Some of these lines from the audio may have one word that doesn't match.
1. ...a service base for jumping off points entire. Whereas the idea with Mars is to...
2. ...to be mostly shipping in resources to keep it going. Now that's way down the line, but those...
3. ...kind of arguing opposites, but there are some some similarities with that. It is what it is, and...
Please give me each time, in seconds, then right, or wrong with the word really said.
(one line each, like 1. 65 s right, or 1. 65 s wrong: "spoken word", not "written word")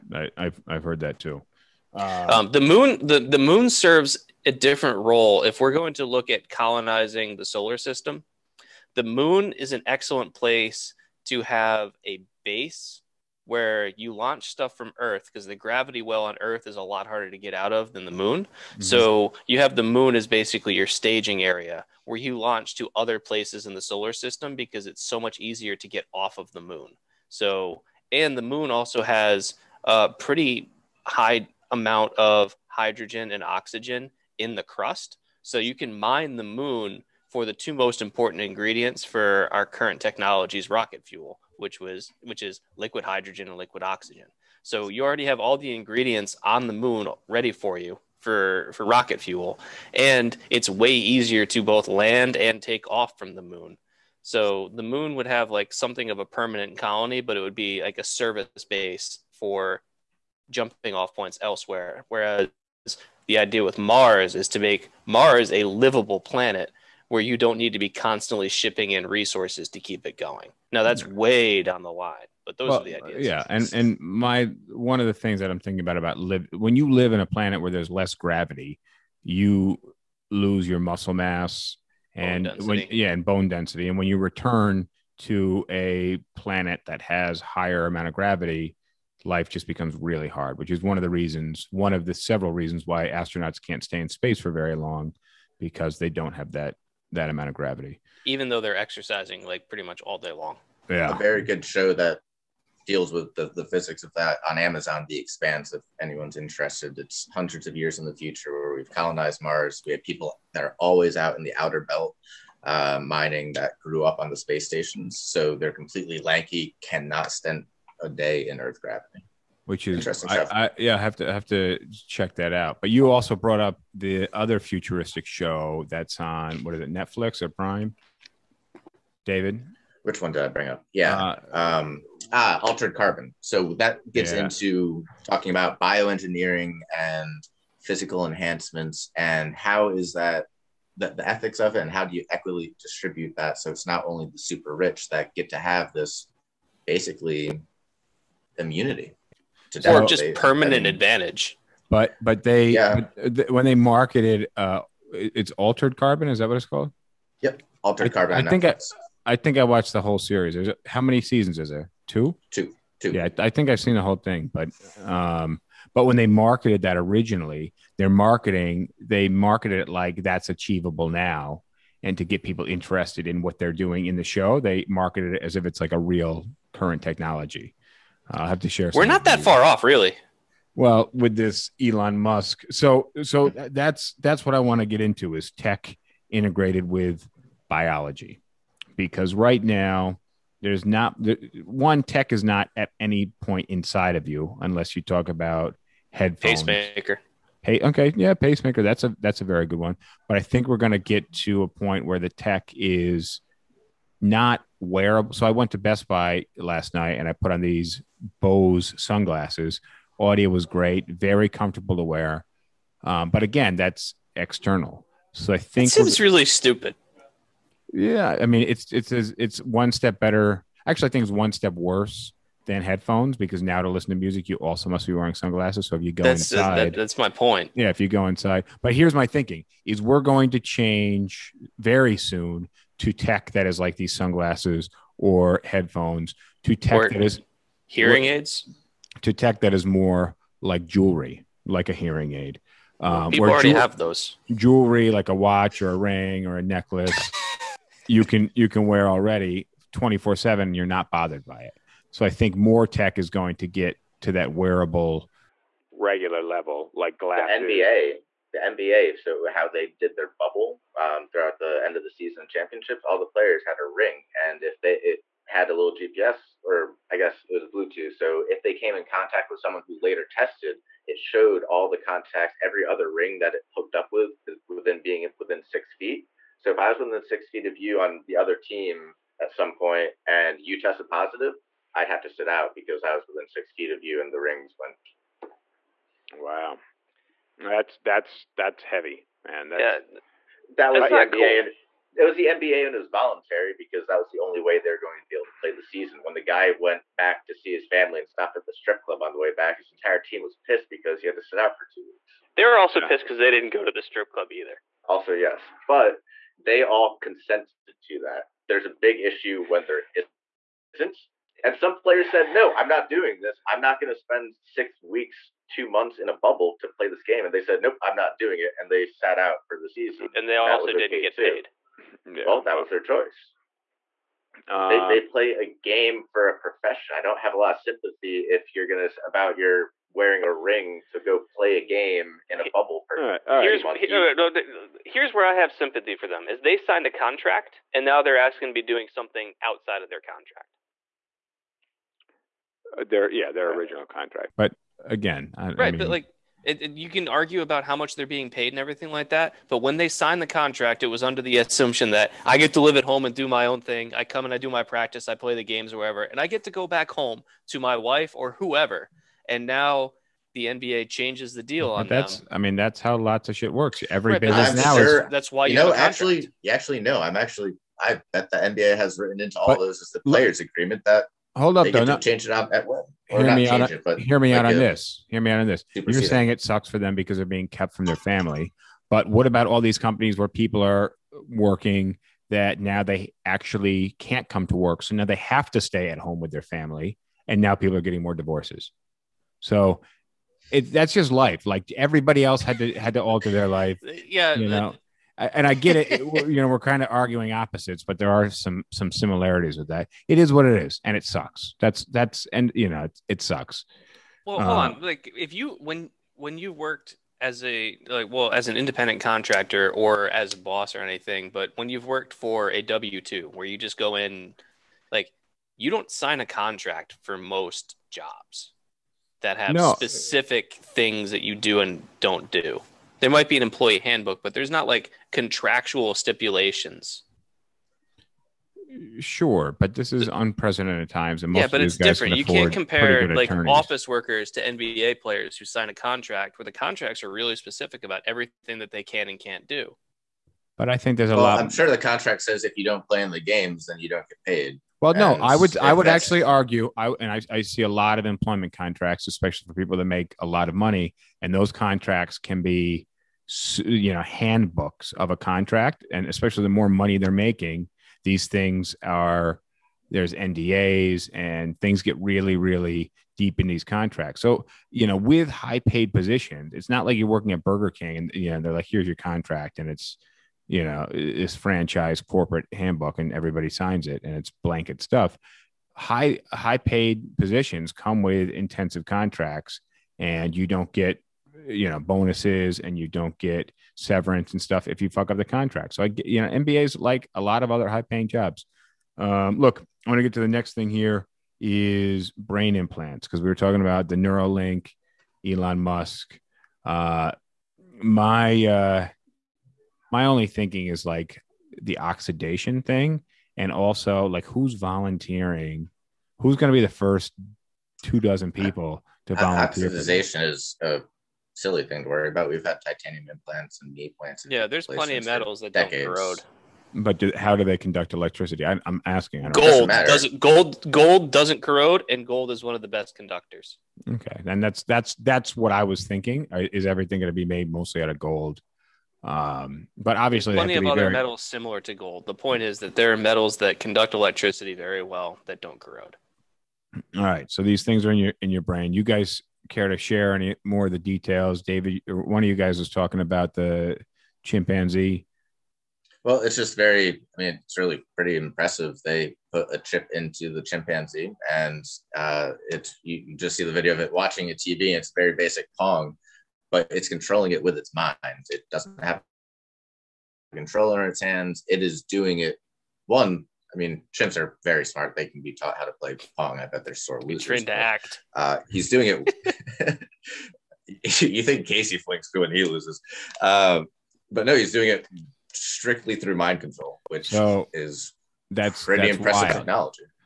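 1. 57 s wrong: "elsewhere", not "entire"
2. 67 s wrong: "constantly", not "mostly"
3. 396 s right.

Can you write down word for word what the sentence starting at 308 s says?
There's a big issue when there isn't.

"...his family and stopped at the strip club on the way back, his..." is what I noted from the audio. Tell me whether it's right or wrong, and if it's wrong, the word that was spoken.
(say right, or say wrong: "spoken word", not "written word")
right.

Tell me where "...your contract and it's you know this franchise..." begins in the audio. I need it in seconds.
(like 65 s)
469 s.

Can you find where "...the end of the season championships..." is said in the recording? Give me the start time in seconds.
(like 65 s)
261 s.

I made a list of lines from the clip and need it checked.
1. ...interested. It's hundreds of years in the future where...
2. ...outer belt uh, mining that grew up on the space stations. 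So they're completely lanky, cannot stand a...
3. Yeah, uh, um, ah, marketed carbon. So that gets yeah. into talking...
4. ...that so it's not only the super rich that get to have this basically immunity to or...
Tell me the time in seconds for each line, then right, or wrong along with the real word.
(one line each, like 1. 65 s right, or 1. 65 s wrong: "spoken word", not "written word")
1. 106 s right
2. 111 s right
3. 130 s wrong: "altered", not "marketed"
4. 143 s right.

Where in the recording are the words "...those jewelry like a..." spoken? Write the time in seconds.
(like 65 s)
243 s.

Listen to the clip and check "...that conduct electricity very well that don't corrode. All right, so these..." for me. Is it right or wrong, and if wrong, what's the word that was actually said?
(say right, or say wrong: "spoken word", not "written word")
right.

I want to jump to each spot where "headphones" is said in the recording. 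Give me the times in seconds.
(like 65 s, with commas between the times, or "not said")
196 s, 222 s, 235 s.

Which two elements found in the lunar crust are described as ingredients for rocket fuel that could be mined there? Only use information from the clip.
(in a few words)
hydrogen and oxygen.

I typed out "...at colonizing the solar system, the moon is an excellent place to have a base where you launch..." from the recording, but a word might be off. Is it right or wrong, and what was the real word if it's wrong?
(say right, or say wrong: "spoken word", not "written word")
right.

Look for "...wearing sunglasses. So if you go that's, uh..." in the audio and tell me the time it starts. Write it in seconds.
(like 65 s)
225 s.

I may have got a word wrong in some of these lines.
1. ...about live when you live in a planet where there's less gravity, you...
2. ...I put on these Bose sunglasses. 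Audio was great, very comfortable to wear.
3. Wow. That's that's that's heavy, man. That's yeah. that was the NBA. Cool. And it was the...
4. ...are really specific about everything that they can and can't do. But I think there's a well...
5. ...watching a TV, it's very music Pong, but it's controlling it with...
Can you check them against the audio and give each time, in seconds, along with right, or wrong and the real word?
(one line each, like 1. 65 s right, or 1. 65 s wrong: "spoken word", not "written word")
1. 75 s right
2. 207 s right
3. 286 s right
4. 437 s right
5. 554 s wrong: "basic", not "music".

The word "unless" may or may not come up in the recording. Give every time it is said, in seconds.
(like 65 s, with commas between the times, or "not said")
194 s.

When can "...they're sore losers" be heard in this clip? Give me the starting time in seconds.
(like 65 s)
566 s.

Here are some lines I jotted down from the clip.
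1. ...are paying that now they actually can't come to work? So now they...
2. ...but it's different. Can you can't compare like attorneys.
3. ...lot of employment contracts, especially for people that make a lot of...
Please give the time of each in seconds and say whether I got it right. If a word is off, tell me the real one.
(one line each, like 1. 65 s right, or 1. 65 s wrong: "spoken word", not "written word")
1. 380 s wrong: "working", not "paying"
2. 431 s right
3. 447 s right.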